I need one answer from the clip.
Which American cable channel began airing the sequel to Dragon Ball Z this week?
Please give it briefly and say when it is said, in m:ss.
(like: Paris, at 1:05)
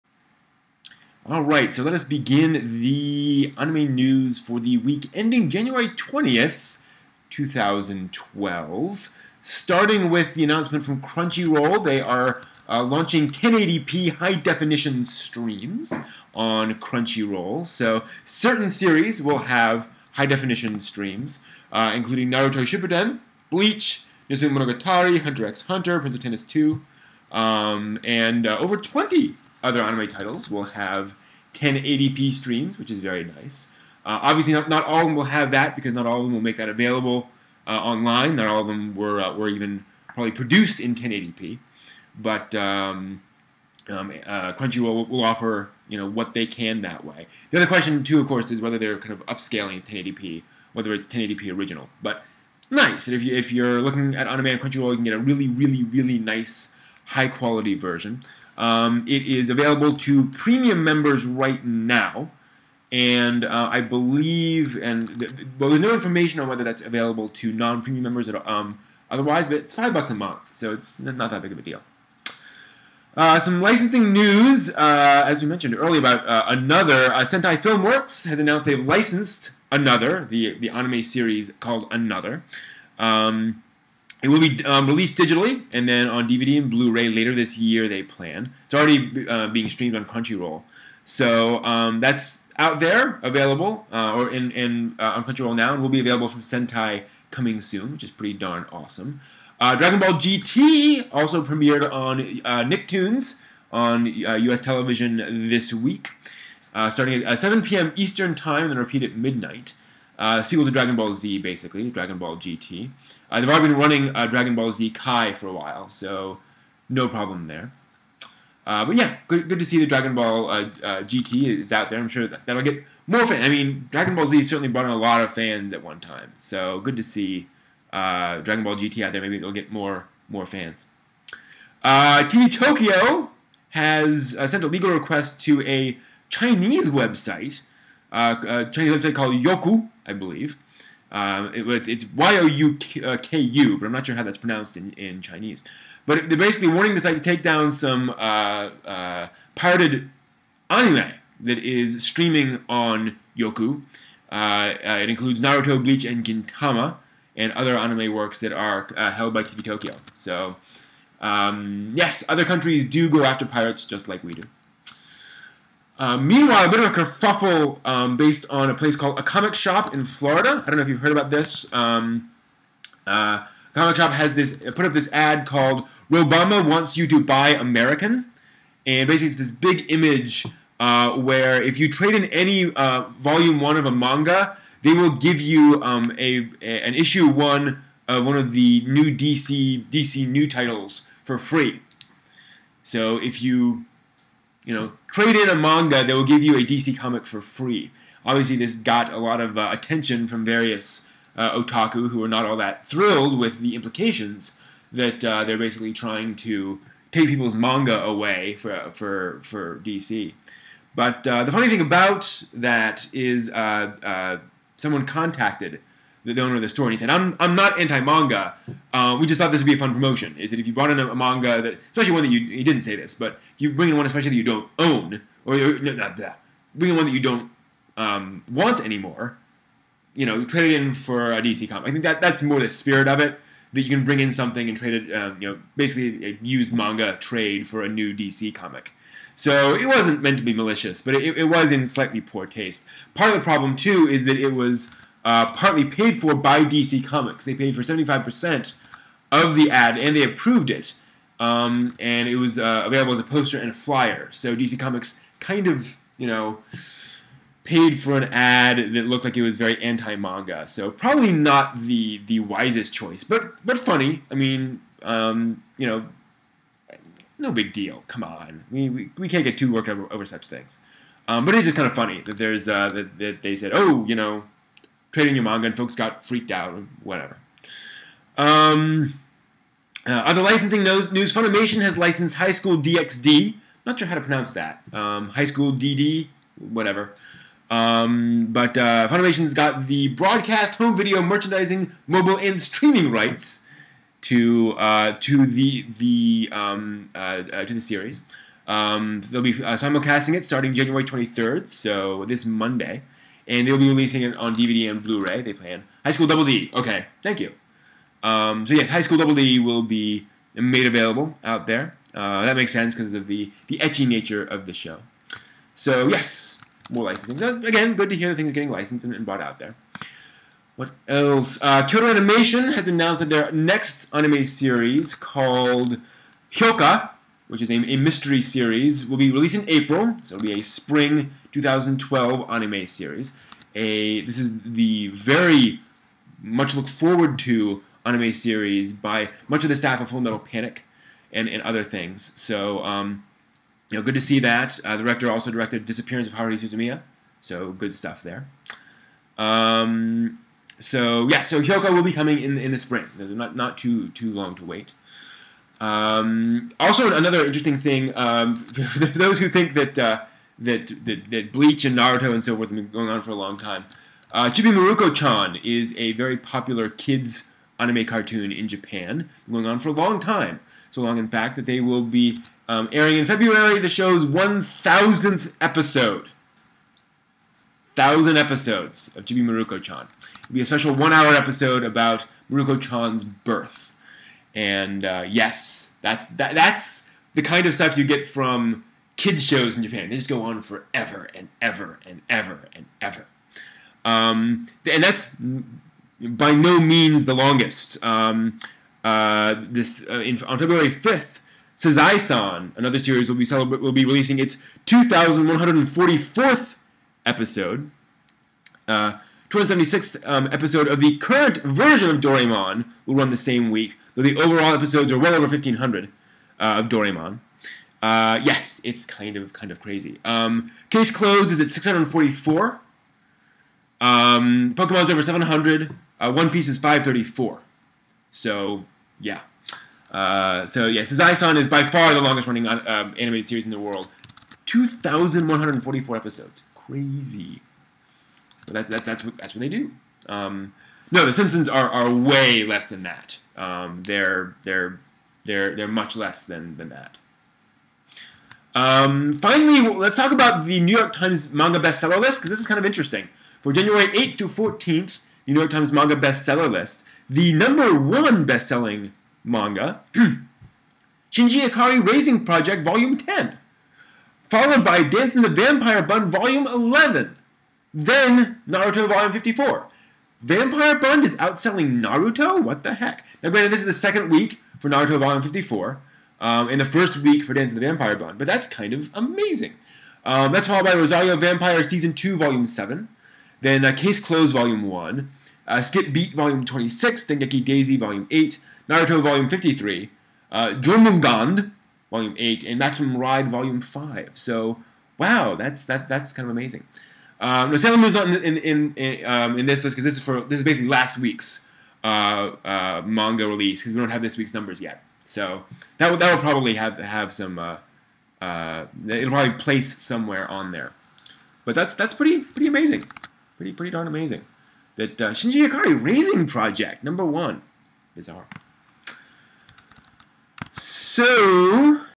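Nicktoons, at 1:42.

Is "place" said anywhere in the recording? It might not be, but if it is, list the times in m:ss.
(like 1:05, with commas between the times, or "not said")
2:48, 8:29.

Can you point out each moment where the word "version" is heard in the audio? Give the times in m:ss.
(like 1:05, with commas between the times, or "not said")
0:57, 6:51.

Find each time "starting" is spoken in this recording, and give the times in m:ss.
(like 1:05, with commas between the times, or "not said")
0:09, 1:46, 5:00.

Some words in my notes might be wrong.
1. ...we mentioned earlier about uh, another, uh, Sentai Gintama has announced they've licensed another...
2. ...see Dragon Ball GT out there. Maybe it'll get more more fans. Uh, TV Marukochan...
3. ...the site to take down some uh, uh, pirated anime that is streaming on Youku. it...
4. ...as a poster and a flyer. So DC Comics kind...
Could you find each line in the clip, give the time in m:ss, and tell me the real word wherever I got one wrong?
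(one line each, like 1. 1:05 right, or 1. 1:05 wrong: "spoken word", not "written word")
1. 1:15 wrong: "Filmworks", not "Gintama"
2. 2:07 wrong: "Tokyo", not "Marukochan"
3. 2:26 right
4. 4:13 right.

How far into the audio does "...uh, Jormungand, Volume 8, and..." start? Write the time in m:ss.
8:10.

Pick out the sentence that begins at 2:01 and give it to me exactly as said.
I'm sure that, that'll get more fans.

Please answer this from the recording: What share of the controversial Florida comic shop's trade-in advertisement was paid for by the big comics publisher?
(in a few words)
75%.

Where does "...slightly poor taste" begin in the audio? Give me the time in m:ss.
4:01.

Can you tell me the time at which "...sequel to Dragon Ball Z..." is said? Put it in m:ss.
1:50.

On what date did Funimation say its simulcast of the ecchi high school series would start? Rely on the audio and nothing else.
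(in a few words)
January 23rd.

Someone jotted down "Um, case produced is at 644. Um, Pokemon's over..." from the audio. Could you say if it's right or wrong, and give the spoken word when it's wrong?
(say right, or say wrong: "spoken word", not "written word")
wrong: "closed", not "produced".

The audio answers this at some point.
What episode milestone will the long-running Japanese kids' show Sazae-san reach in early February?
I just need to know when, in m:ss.
6:44.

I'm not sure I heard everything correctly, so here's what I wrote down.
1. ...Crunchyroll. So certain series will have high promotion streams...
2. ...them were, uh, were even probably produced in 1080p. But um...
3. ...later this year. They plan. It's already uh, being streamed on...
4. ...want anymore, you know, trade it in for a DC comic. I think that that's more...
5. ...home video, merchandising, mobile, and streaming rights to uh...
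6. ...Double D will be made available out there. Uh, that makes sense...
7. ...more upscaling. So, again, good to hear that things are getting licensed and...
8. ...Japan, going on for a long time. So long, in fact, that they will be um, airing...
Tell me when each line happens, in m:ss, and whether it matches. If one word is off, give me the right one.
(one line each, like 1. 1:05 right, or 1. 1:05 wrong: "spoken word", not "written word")
1. 0:16 wrong: "definition", not "promotion"
2. 0:38 right
3. 1:27 right
4. 3:48 right
5. 4:50 right
6. 5:09 right
7. 5:16 wrong: "licensing", not "upscaling"
8. 6:08 right.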